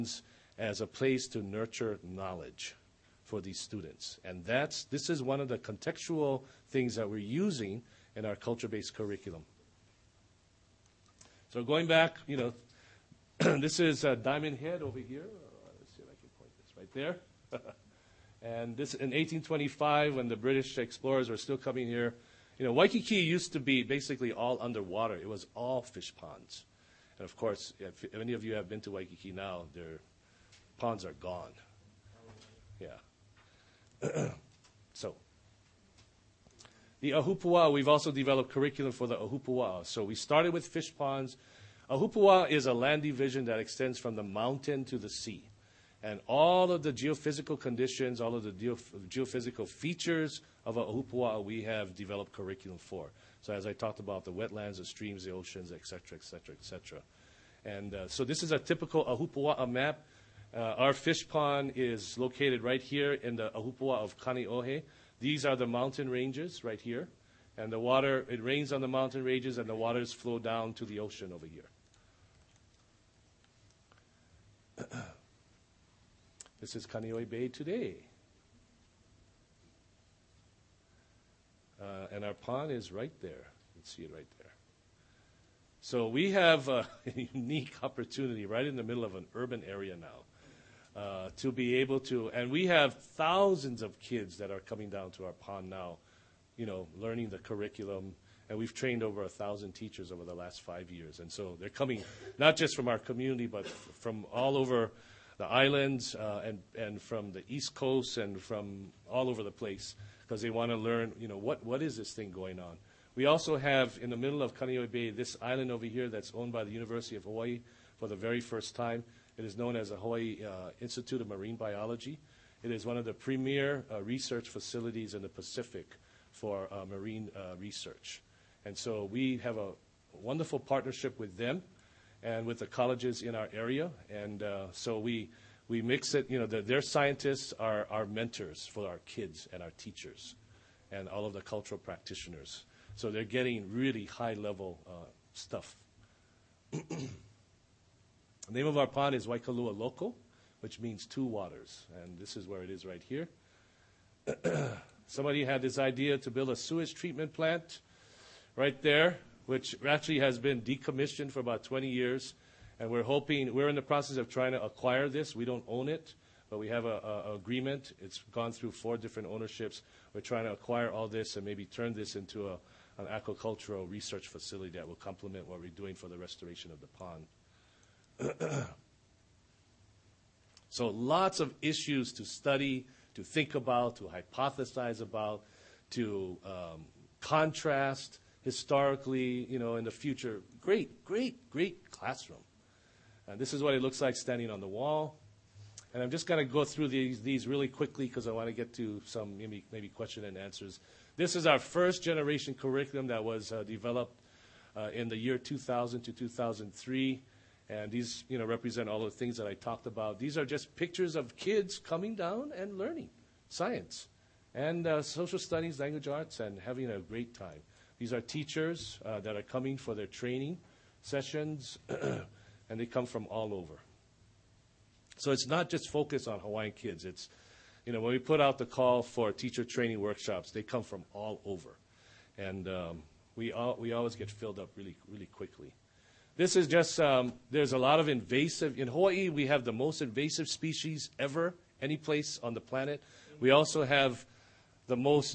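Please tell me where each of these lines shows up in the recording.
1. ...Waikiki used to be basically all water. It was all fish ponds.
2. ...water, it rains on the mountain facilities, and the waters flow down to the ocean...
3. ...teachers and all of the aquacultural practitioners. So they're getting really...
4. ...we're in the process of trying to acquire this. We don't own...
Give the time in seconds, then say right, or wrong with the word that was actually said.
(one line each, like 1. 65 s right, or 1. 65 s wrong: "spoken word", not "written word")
1. 22 s wrong: "underwater", not "water"
2. 67 s wrong: "ranges", not "facilities"
3. 139 s wrong: "cultural", not "aquacultural"
4. 163 s right.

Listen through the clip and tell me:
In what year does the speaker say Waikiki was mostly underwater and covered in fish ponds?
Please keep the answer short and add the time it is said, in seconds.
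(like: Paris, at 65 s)
1825, at 19 s.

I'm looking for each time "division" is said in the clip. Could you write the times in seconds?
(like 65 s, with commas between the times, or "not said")
43 s.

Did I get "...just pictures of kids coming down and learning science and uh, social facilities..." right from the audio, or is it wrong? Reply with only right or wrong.
wrong.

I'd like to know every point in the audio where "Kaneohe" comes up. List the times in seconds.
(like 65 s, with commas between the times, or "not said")
64 s, 76 s, 114 s.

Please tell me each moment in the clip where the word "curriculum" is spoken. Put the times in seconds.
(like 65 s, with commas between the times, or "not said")
8 s, 38 s, 52 s, 97 s, 202 s.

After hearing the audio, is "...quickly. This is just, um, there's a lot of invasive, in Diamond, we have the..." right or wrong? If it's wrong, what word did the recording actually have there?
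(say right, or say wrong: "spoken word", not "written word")
wrong: "Hawaii", not "Diamond".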